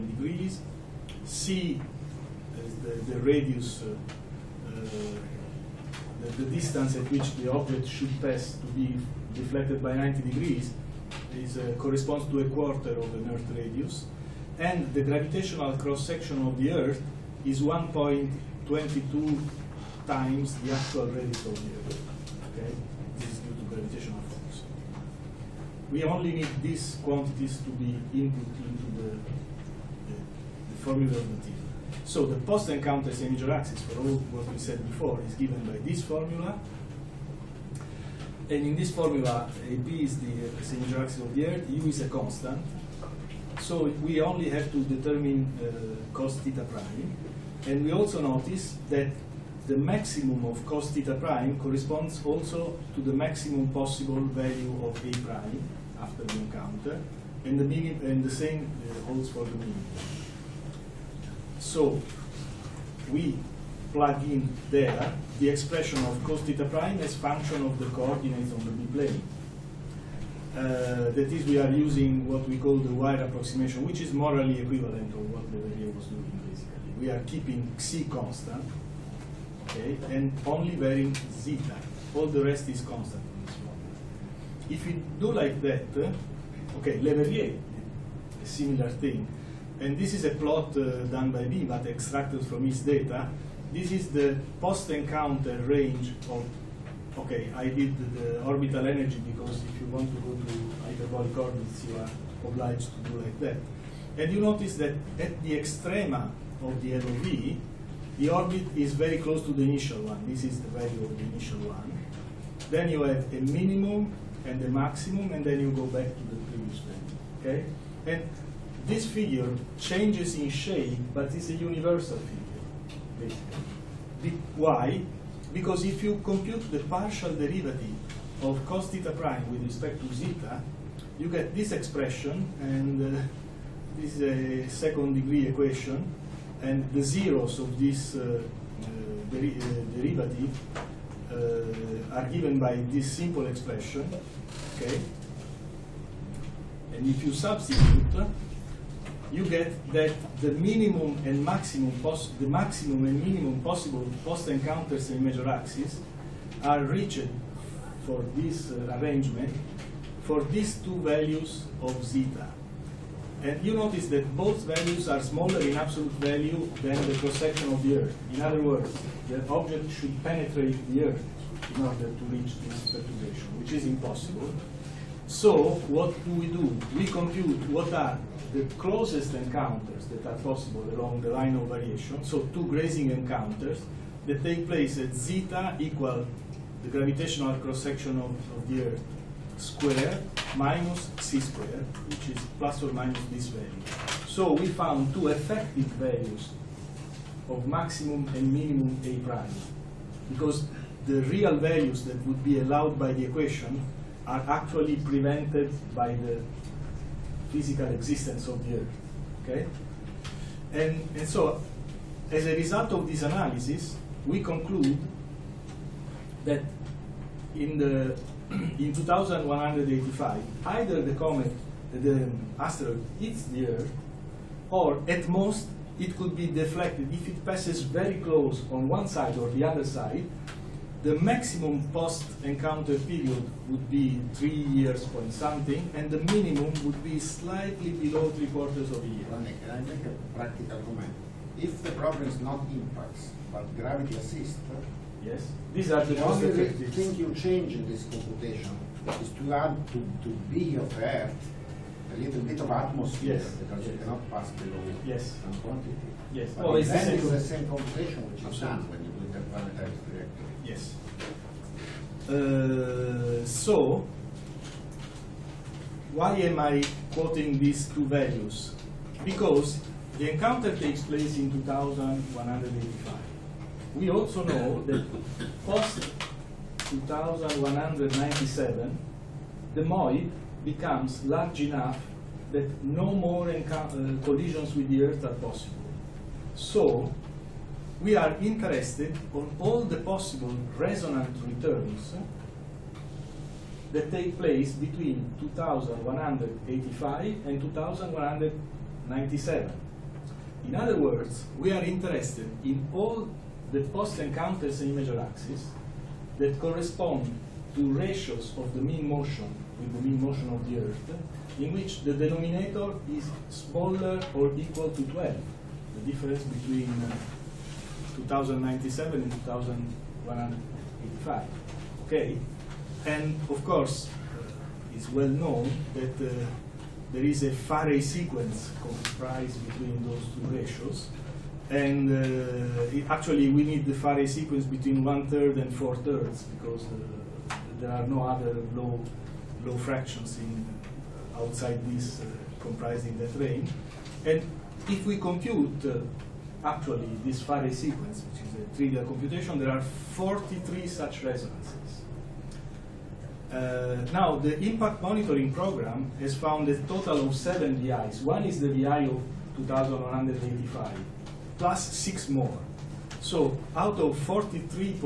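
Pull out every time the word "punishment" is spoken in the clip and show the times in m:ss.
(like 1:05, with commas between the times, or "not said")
not said.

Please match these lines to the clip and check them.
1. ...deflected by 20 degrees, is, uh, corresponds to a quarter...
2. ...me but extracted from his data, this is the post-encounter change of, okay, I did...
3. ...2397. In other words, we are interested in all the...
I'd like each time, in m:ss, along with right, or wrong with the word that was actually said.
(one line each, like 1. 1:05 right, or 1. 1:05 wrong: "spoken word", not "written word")
1. 0:09 wrong: "90", not "20"
2. 1:31 wrong: "range", not "change"
3. 4:57 wrong: "2197", not "2397".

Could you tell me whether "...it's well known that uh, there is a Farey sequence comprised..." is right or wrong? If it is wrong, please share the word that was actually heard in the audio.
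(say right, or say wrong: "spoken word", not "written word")
right.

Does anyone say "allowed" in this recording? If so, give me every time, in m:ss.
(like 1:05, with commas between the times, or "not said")
3:22.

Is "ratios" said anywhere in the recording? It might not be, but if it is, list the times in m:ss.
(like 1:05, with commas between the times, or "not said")
5:07, 5:30.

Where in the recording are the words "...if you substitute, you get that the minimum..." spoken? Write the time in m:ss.
2:27.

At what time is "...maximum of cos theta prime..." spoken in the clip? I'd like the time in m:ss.
0:49.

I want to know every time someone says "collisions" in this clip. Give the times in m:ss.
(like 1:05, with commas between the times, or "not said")
4:44.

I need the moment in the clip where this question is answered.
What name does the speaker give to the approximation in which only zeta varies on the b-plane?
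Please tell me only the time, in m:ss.
1:12.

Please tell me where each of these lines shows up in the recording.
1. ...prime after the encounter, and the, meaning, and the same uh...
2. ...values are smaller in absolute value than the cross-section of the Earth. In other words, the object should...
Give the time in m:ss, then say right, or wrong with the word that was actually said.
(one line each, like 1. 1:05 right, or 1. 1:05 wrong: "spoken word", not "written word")
1. 0:55 right
2. 2:44 right.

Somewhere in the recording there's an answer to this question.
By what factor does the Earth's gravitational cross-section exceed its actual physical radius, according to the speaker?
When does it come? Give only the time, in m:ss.
0:17.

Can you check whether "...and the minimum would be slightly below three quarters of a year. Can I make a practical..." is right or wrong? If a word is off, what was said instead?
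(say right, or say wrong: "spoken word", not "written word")
right.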